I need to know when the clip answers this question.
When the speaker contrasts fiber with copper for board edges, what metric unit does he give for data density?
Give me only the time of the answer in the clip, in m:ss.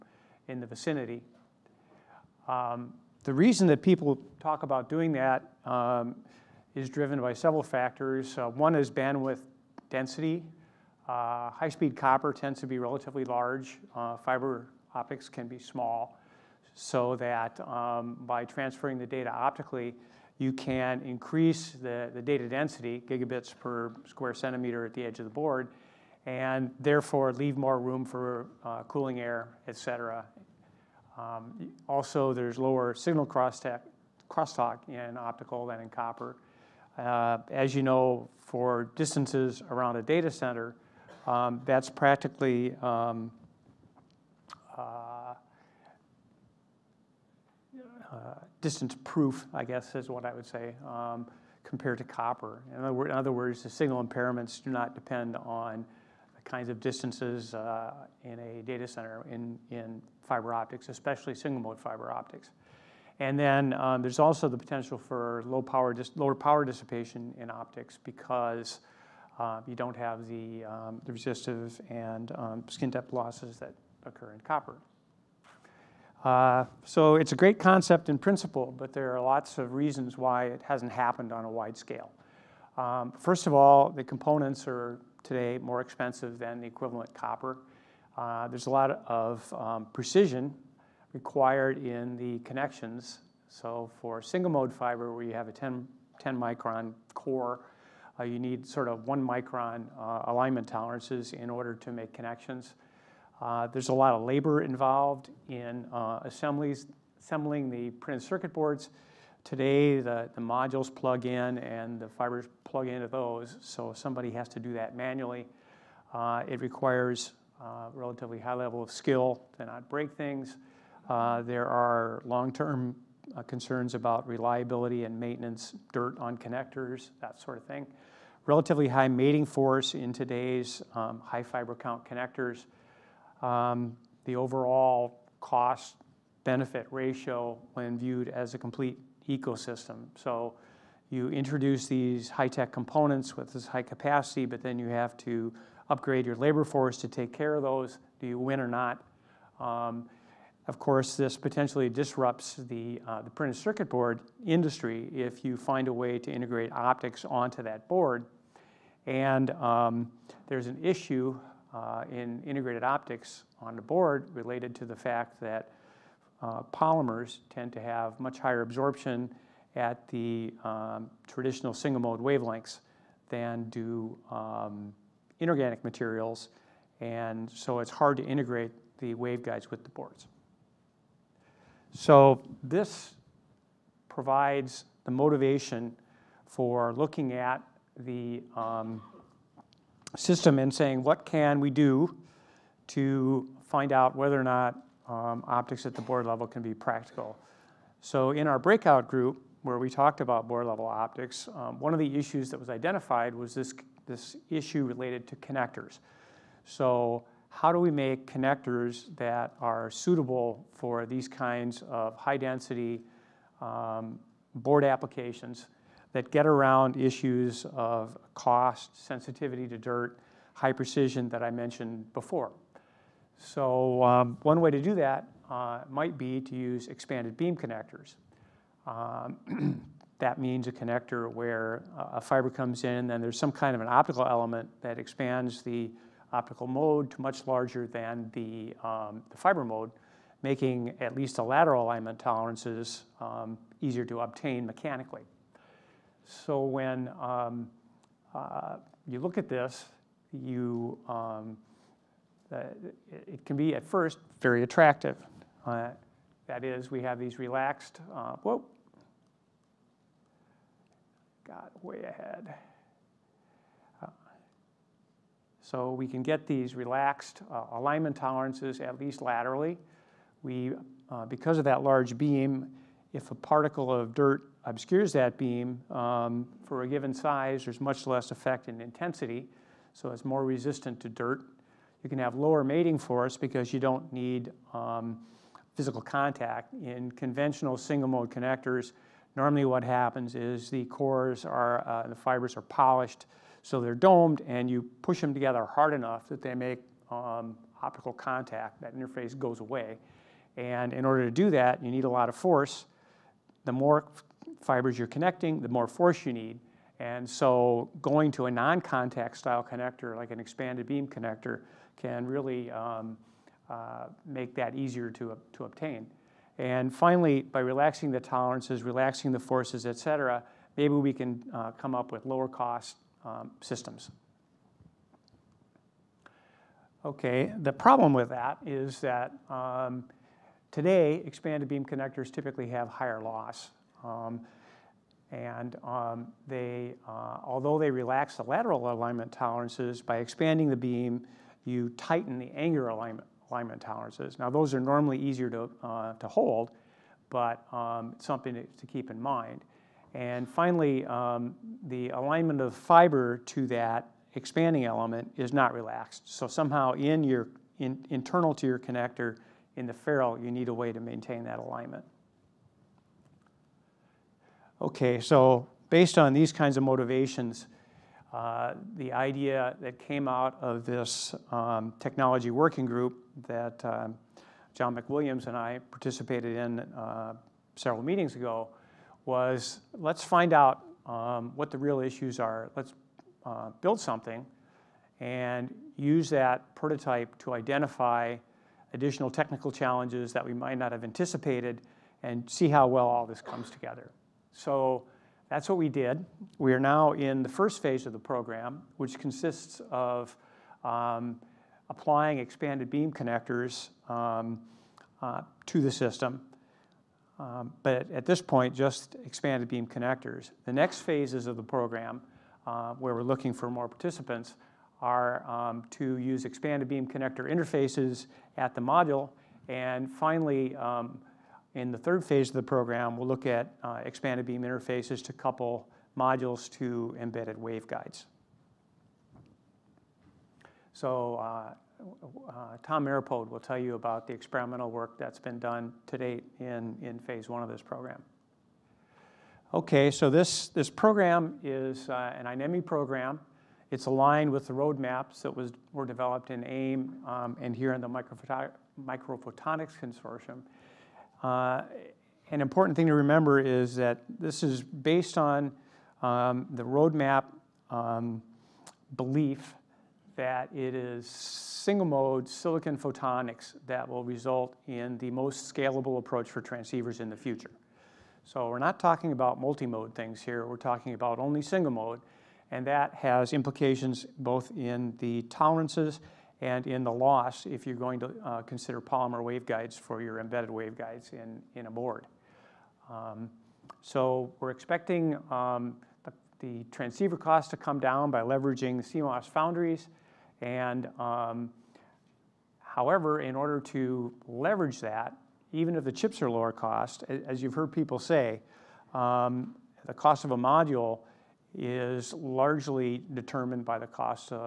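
0:23.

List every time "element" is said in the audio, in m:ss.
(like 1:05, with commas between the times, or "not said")
3:54, 5:54.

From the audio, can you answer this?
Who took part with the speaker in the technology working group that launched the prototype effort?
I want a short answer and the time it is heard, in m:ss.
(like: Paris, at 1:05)
John McWilliams, at 6:14.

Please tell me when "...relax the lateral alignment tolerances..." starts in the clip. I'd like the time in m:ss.
5:37.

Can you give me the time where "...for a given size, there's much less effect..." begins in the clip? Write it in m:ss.
4:36.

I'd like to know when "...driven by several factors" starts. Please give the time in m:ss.
0:06.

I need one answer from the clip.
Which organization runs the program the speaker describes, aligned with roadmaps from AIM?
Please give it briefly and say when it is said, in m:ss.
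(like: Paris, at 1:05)
INEMI, at 7:22.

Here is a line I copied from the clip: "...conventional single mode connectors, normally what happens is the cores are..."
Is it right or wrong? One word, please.
right.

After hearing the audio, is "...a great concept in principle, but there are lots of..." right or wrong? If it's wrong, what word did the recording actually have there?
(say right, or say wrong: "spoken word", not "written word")
right.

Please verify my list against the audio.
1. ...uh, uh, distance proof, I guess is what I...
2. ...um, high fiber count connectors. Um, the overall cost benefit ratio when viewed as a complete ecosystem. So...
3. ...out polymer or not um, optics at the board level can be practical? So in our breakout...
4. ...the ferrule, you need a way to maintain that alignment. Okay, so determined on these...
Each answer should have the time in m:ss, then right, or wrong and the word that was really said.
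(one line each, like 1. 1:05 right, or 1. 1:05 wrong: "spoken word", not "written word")
1. 0:44 right
2. 2:10 right
3. 3:13 wrong: "whether", not "polymer"
4. 5:59 wrong: "based", not "determined".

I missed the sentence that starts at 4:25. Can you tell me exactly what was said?
So we can get these relaxed uh, alignment tolerances, at least laterally.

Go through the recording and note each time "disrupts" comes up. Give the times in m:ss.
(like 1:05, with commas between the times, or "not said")
2:31.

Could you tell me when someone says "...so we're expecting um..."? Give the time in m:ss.
8:04.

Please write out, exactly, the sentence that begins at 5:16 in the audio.
And finally, by relaxing the tolerances, relaxing the forces, et cetera, maybe we can uh, come up with lower cost um, systems.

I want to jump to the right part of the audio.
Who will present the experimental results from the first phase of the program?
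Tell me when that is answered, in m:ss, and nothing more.
7:12.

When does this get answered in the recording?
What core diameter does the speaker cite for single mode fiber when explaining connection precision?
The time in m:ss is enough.
1:36.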